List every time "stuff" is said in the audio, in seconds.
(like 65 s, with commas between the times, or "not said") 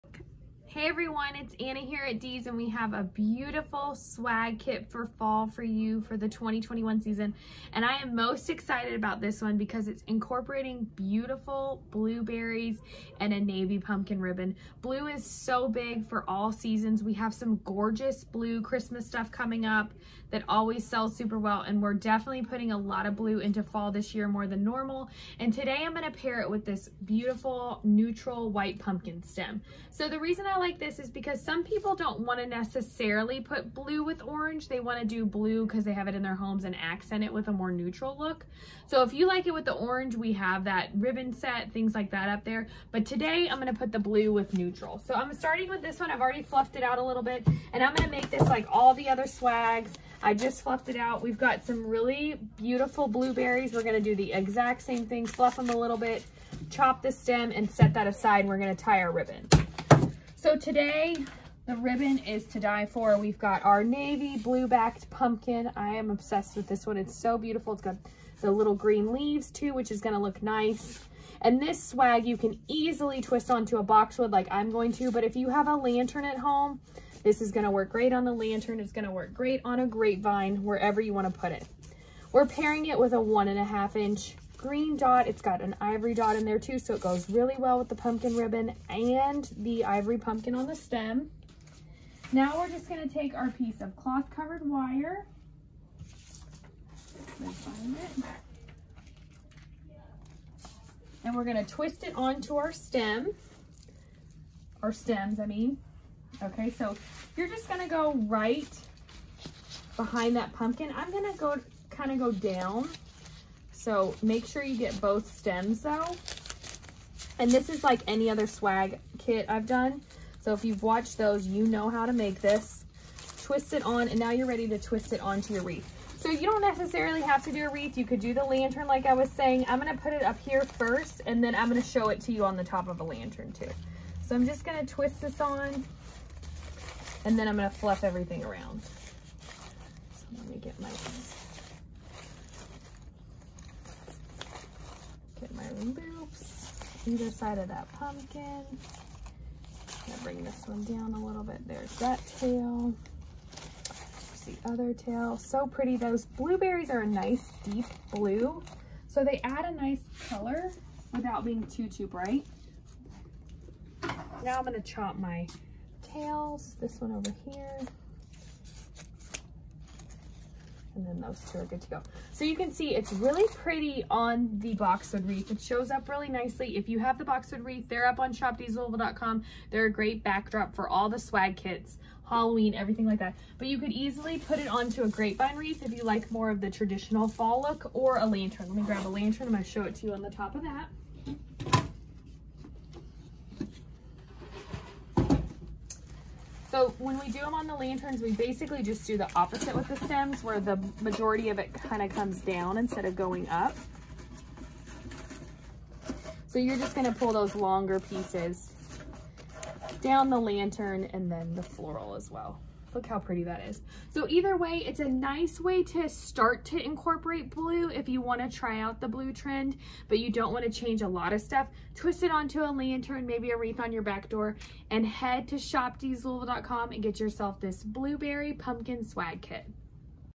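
19 s, 221 s.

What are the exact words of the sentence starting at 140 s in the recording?
So let me get my my loops either side of that pumpkin.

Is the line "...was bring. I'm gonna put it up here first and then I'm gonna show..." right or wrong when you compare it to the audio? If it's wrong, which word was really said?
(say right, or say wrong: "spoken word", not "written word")
wrong: "saying", not "bring".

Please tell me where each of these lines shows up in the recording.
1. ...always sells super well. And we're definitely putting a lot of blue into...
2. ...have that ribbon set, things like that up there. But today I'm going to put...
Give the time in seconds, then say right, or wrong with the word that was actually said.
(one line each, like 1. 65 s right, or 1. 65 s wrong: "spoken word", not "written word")
1. 20 s right
2. 40 s right.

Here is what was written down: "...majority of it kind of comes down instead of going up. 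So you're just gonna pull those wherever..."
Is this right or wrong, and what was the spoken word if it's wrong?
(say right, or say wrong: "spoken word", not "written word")
wrong: "longer", not "wherever".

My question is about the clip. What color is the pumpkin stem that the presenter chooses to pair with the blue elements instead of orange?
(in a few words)
neutral white.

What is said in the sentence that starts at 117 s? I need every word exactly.
And this is like any other swag kit I've done.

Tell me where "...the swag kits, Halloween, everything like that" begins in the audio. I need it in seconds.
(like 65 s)
181 s.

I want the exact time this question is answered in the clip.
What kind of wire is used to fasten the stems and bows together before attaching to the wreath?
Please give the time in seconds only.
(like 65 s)
93 s.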